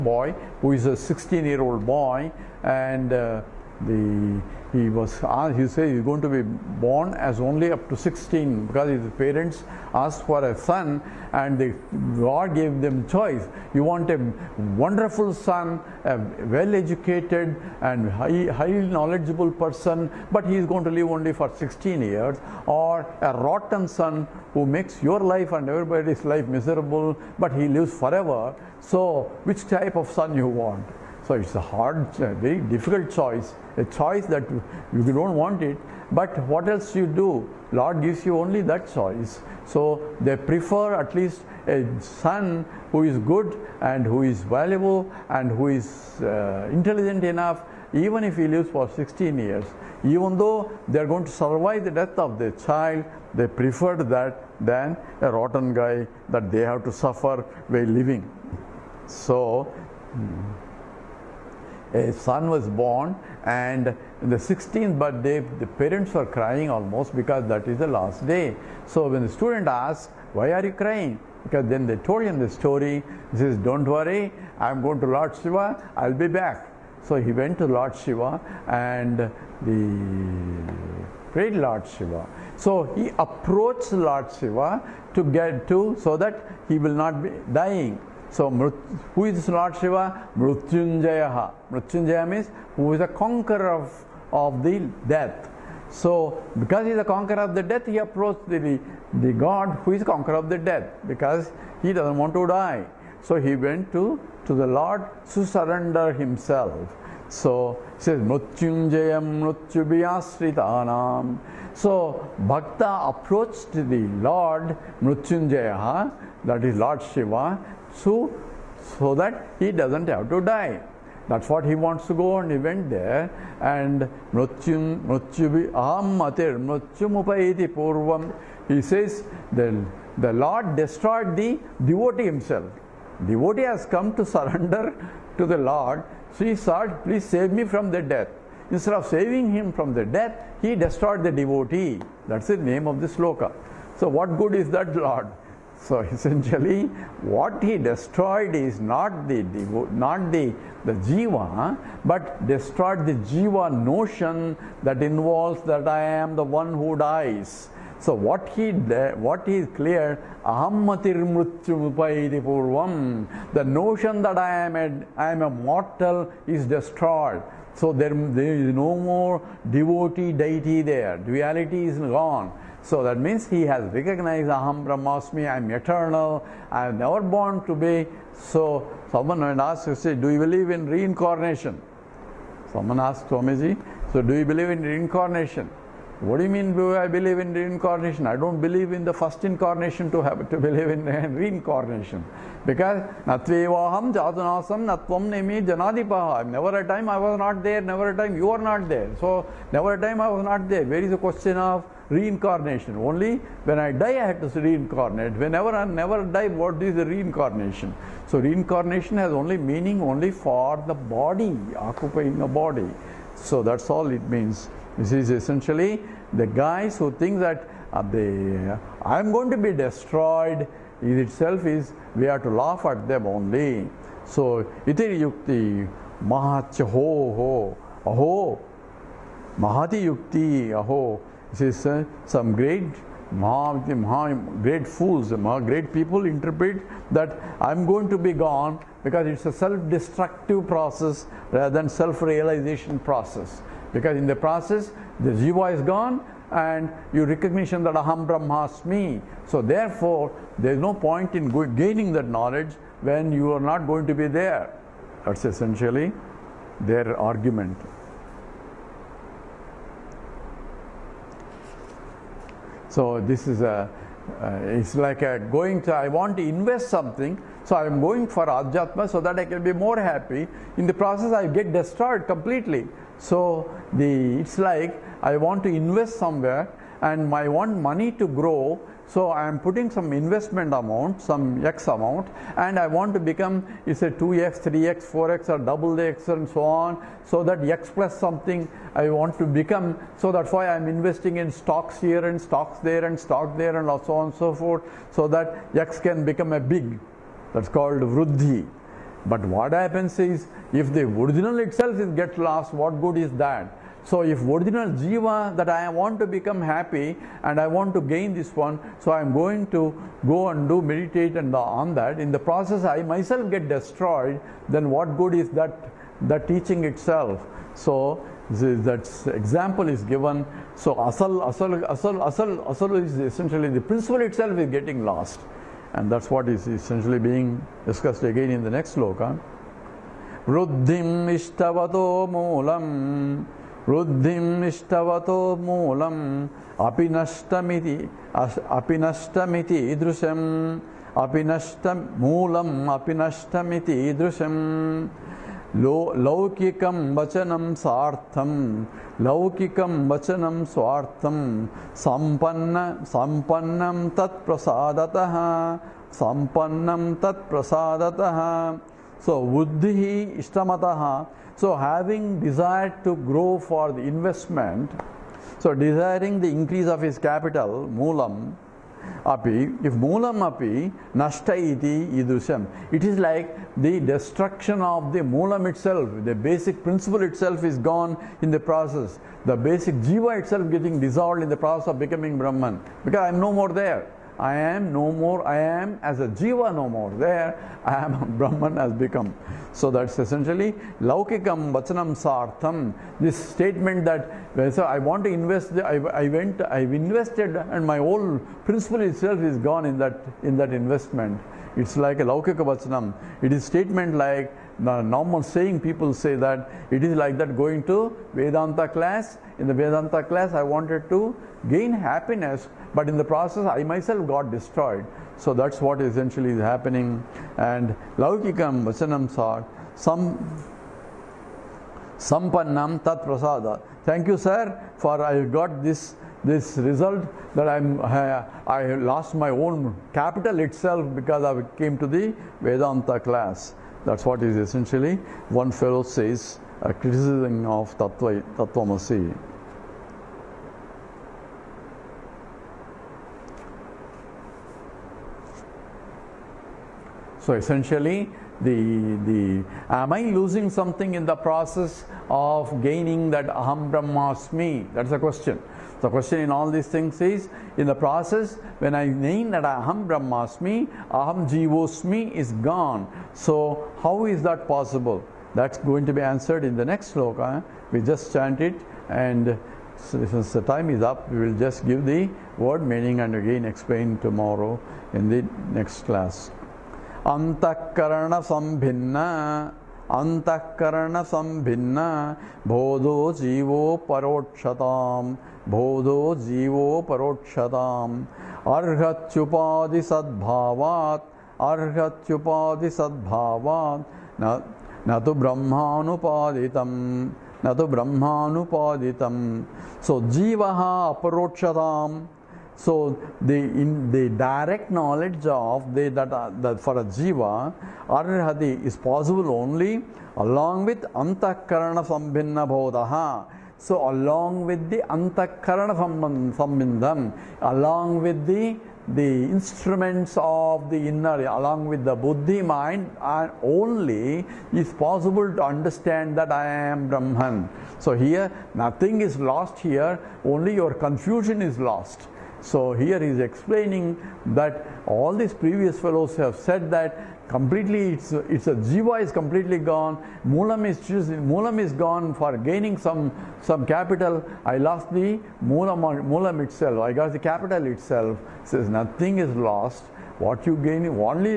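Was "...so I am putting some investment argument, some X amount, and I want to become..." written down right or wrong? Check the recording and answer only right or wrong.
wrong.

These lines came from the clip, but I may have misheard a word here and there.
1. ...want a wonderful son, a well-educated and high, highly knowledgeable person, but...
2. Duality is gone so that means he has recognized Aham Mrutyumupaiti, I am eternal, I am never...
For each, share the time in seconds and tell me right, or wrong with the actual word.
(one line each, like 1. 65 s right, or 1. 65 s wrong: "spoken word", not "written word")
1. 13 s right
2. 171 s wrong: "Brahmasmi", not "Mrutyumupaiti".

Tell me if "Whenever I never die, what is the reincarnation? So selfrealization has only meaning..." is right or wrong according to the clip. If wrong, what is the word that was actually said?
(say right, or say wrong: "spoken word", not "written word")
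wrong: "reincarnation", not "selfrealization".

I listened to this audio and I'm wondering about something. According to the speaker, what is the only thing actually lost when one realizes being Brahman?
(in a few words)
your confusion.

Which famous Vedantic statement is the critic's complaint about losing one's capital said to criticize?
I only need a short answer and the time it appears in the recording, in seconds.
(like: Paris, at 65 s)
Tattvamasi, at 438 s.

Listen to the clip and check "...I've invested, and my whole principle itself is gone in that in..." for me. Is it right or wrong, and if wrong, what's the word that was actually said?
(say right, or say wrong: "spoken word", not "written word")
right.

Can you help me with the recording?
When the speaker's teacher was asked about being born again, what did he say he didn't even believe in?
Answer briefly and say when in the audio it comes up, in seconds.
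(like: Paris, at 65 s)
the first incarnation, at 189 s.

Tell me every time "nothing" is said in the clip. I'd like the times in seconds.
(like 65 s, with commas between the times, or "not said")
528 s, 548 s.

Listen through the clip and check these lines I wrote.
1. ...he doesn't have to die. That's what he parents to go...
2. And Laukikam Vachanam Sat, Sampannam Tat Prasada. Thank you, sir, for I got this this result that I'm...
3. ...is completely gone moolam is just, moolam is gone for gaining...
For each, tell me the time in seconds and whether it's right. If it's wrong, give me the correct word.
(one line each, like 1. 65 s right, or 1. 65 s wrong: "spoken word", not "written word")
1. 119 s wrong: "wants", not "parents"
2. 417 s right
3. 539 s right.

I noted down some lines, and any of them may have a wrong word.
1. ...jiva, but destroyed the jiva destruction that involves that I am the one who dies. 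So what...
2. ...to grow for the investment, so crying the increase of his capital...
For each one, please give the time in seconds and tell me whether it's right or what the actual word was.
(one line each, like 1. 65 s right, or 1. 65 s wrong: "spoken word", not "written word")
1. 151 s wrong: "notion", not "destruction"
2. 363 s wrong: "desiring", not "crying".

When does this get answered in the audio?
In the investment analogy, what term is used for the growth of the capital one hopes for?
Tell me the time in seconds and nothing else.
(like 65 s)
298 s.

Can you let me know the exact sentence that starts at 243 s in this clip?
Because in the process, the jiva is gone and you recognition that aham brahmasmi.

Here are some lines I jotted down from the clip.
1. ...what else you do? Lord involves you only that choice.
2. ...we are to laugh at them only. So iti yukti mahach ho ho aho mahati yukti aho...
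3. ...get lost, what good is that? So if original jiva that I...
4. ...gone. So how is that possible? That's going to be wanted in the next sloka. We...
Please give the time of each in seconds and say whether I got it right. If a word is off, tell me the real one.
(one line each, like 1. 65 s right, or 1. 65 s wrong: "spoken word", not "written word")
1. 36 s wrong: "gives", not "involves"
2. 222 s right
3. 302 s right
4. 462 s wrong: "answered", not "wanted".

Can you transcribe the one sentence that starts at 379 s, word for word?
The basic jiva itself getting dissolved in the process of becoming Brahman, because I am no more there.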